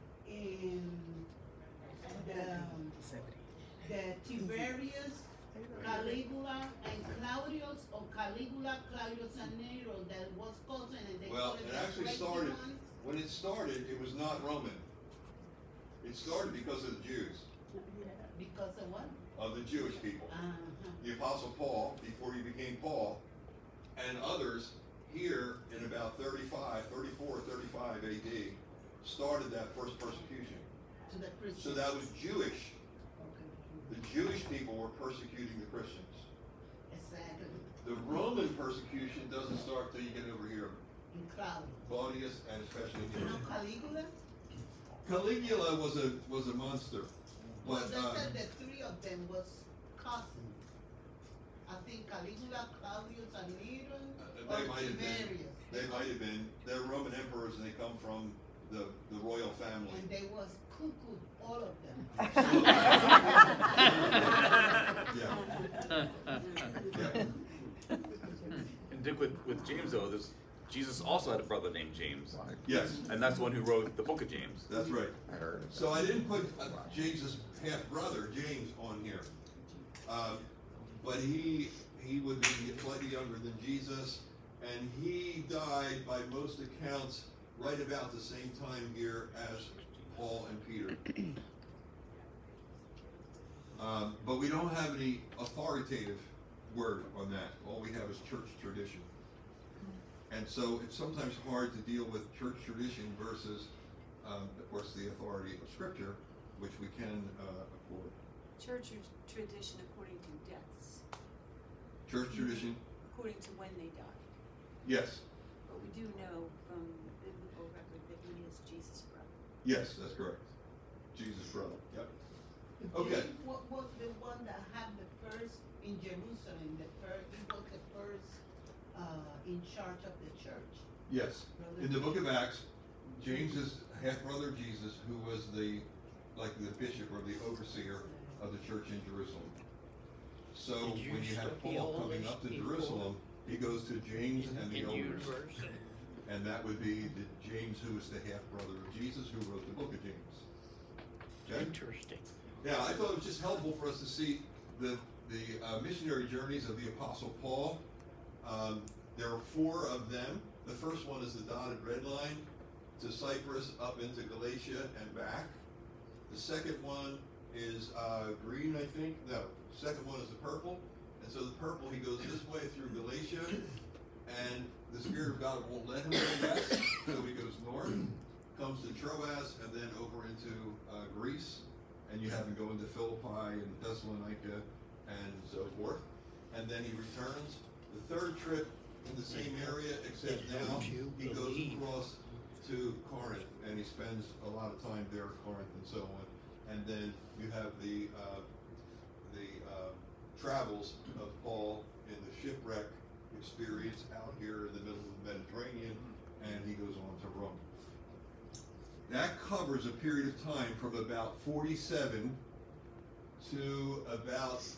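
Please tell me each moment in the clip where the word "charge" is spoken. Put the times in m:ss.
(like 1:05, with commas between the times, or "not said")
2:09.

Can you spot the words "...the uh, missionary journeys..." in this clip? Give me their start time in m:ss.
2:35.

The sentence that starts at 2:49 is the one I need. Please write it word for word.
No, second one is the purple.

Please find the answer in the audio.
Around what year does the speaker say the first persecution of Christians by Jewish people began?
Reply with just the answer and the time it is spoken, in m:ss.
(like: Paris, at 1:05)
35 AD, at 0:26.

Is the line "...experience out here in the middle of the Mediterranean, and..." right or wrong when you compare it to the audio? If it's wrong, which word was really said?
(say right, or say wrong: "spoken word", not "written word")
right.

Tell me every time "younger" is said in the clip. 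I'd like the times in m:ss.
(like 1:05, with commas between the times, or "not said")
1:23.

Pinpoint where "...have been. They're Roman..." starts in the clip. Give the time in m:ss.
0:56.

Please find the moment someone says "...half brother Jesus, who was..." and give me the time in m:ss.
2:14.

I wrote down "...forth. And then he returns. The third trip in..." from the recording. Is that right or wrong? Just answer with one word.
right.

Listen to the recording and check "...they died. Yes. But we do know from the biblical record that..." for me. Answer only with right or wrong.
right.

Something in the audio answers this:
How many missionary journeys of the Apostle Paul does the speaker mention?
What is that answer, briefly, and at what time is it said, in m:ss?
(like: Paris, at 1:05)
4, at 2:39.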